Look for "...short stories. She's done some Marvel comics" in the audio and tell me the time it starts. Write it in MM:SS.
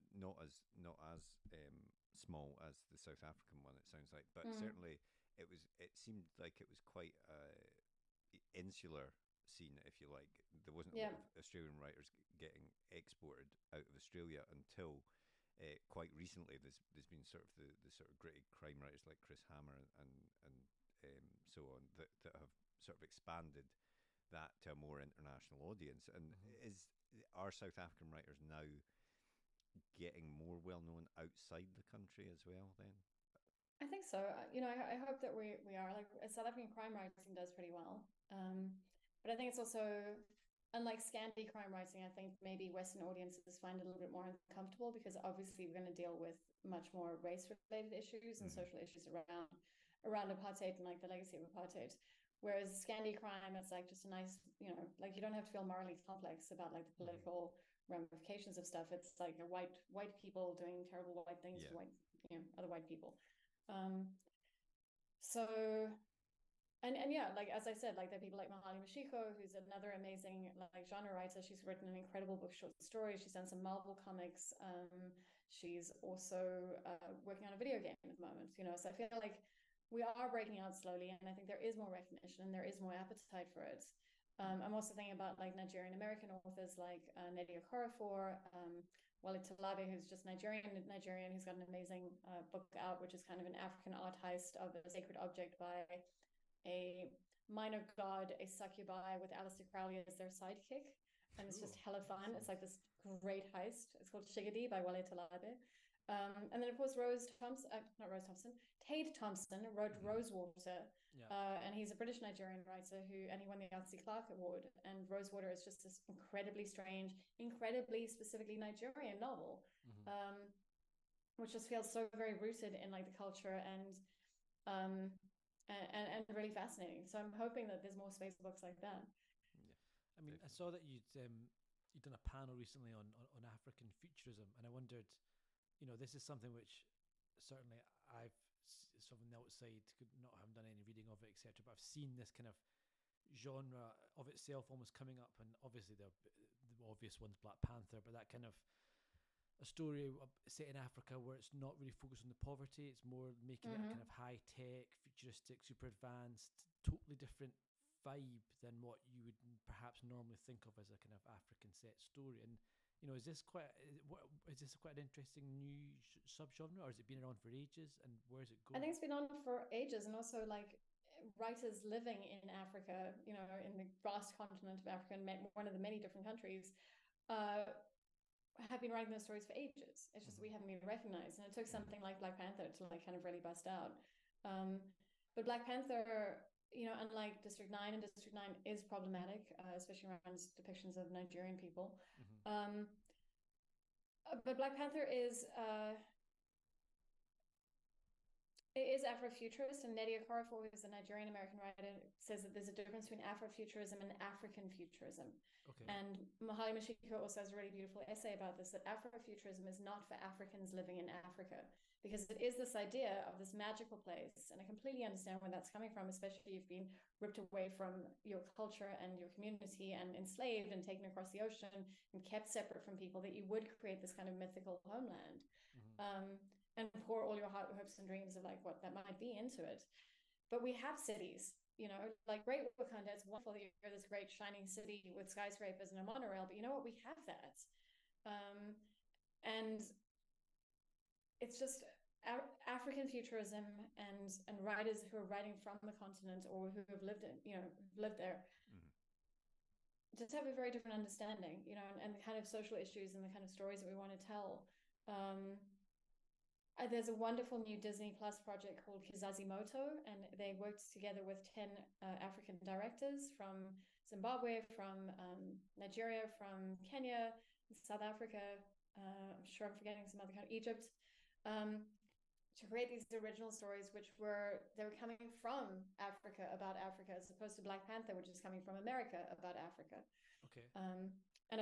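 01:12.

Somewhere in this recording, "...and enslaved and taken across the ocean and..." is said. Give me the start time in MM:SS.
03:39.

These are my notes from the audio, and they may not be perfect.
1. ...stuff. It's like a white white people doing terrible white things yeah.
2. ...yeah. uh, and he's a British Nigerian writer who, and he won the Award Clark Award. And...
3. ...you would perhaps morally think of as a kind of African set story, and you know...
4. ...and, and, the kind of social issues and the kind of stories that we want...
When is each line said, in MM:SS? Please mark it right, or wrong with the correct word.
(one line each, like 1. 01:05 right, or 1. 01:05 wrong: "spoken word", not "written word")
1. 00:58 right
2. 01:51 wrong: "Elsie", not "Award"
3. 02:39 wrong: "normally", not "morally"
4. 04:11 right.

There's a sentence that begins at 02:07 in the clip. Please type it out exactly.
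So I'm hoping that there's more space books like that.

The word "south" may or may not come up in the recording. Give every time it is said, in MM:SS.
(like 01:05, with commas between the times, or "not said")
00:02, 00:27, 00:36, 04:27.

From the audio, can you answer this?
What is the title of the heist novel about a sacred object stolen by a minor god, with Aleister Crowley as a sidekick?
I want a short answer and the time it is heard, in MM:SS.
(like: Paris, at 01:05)
Shigidi, at 01:44.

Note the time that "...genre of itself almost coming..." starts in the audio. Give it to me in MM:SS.
02:23.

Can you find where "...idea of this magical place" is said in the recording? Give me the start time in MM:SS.
03:32.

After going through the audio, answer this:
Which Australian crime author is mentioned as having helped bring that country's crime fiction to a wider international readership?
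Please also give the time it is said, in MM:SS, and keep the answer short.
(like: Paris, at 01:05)
Chris Hammer, at 00:19.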